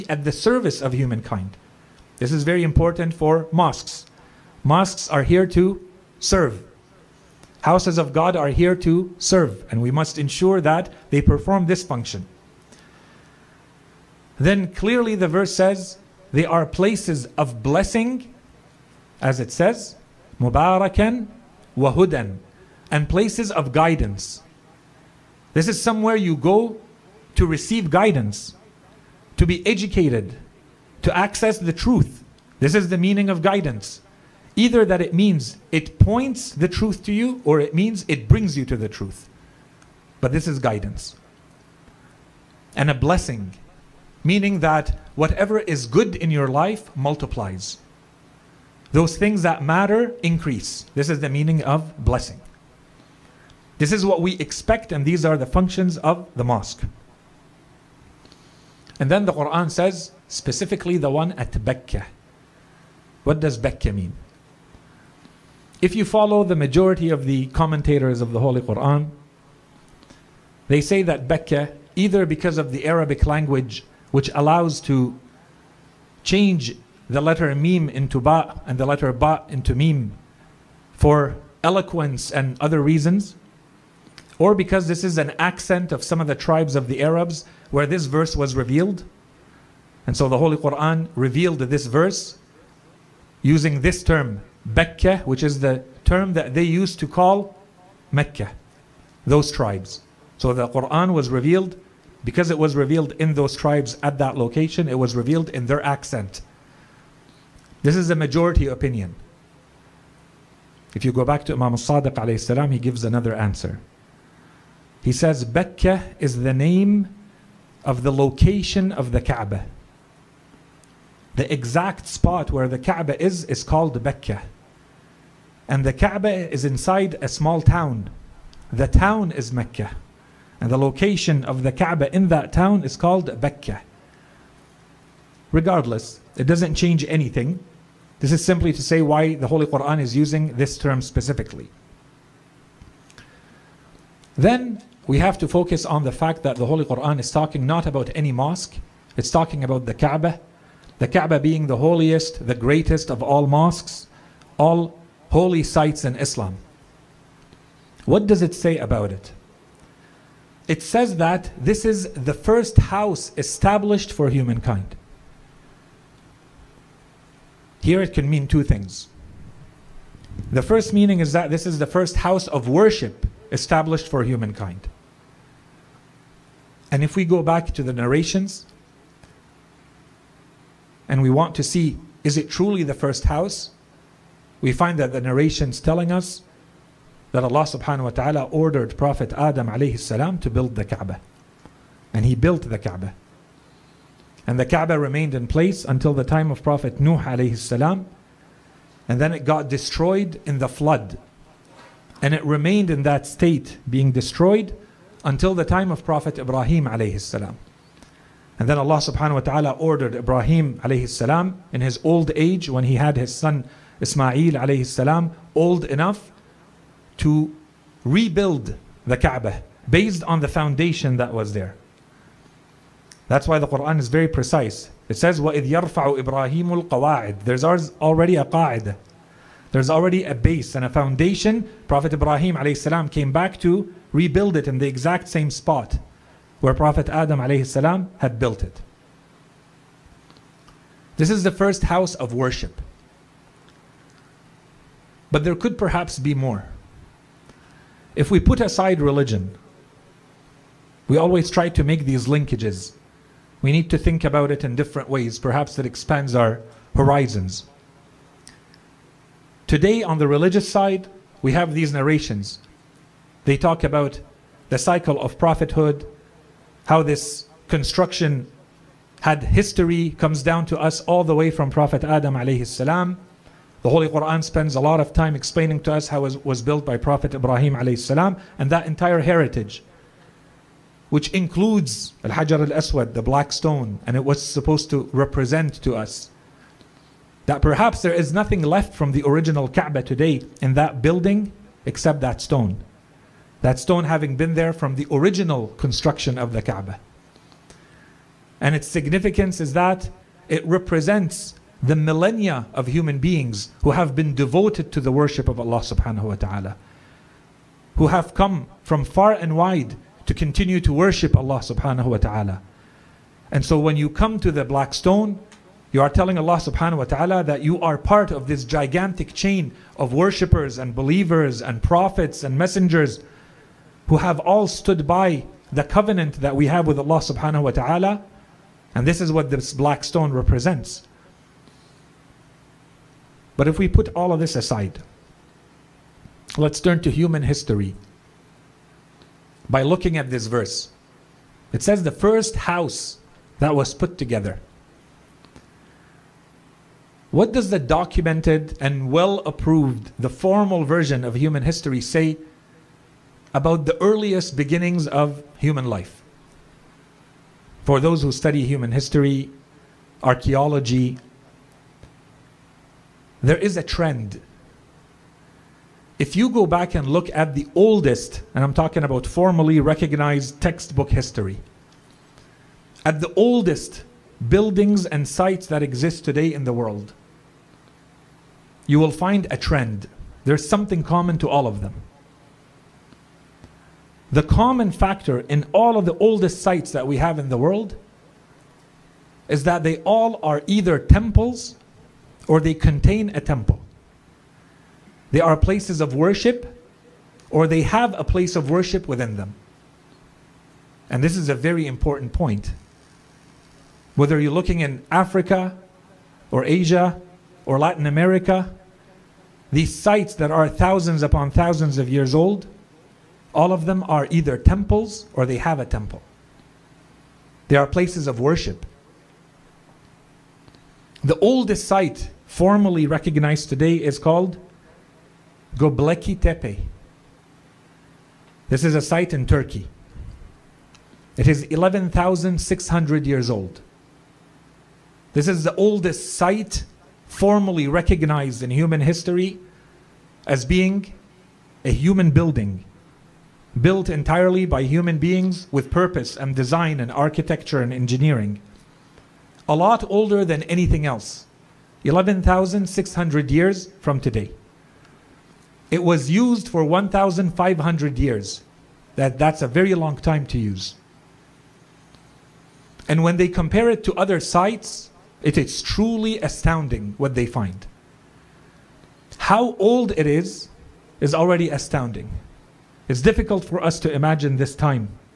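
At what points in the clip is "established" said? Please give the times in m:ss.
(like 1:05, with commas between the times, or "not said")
2:43, 2:53.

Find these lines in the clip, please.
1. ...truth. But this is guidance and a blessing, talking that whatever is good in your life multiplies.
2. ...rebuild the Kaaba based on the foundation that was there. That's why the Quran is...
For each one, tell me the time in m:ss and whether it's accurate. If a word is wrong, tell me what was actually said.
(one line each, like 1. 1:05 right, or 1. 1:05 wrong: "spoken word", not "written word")
1. 0:38 wrong: "meaning", not "talking"
2. 3:38 right.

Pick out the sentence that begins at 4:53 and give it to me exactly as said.
That stone having been there from the original construction of the Kaaba.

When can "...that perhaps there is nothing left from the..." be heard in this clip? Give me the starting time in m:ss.
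4:47.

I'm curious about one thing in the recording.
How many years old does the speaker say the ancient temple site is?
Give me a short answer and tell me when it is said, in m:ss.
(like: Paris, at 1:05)
11,600, at 7:11.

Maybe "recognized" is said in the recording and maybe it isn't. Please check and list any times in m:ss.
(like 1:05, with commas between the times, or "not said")
6:09, 7:03, 7:17.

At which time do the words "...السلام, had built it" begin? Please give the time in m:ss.
3:57.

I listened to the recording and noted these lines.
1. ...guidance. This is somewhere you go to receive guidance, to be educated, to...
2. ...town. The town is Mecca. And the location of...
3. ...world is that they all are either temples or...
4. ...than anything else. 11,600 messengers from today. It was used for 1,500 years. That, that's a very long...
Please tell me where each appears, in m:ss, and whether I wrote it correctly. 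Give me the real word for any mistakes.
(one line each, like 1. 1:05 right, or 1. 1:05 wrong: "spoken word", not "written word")
1. 0:23 right
2. 2:07 right
3. 6:27 right
4. 7:30 wrong: "years", not "messengers".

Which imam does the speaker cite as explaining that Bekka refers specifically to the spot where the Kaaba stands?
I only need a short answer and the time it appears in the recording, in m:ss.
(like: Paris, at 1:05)
Imam al-Sadiq, at 1:51.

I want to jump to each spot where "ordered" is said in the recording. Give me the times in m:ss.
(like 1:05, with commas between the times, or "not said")
3:08, 3:29.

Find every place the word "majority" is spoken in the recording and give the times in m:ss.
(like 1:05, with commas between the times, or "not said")
1:06, 1:48.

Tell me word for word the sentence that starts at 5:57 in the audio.
For those who study human history, archaeology, there is a trend.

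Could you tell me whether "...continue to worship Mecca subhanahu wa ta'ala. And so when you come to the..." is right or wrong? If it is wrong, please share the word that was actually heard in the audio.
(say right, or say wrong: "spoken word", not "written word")
wrong: "Allah", not "Mecca".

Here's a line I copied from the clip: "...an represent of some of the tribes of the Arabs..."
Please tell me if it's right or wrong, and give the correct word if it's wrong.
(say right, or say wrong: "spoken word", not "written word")
wrong: "accent", not "represent".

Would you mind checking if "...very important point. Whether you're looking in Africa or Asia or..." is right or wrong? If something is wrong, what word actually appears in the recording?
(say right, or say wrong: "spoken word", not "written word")
right.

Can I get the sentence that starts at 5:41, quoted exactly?
It says the first house that was put together.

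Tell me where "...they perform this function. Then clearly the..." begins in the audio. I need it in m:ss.
0:11.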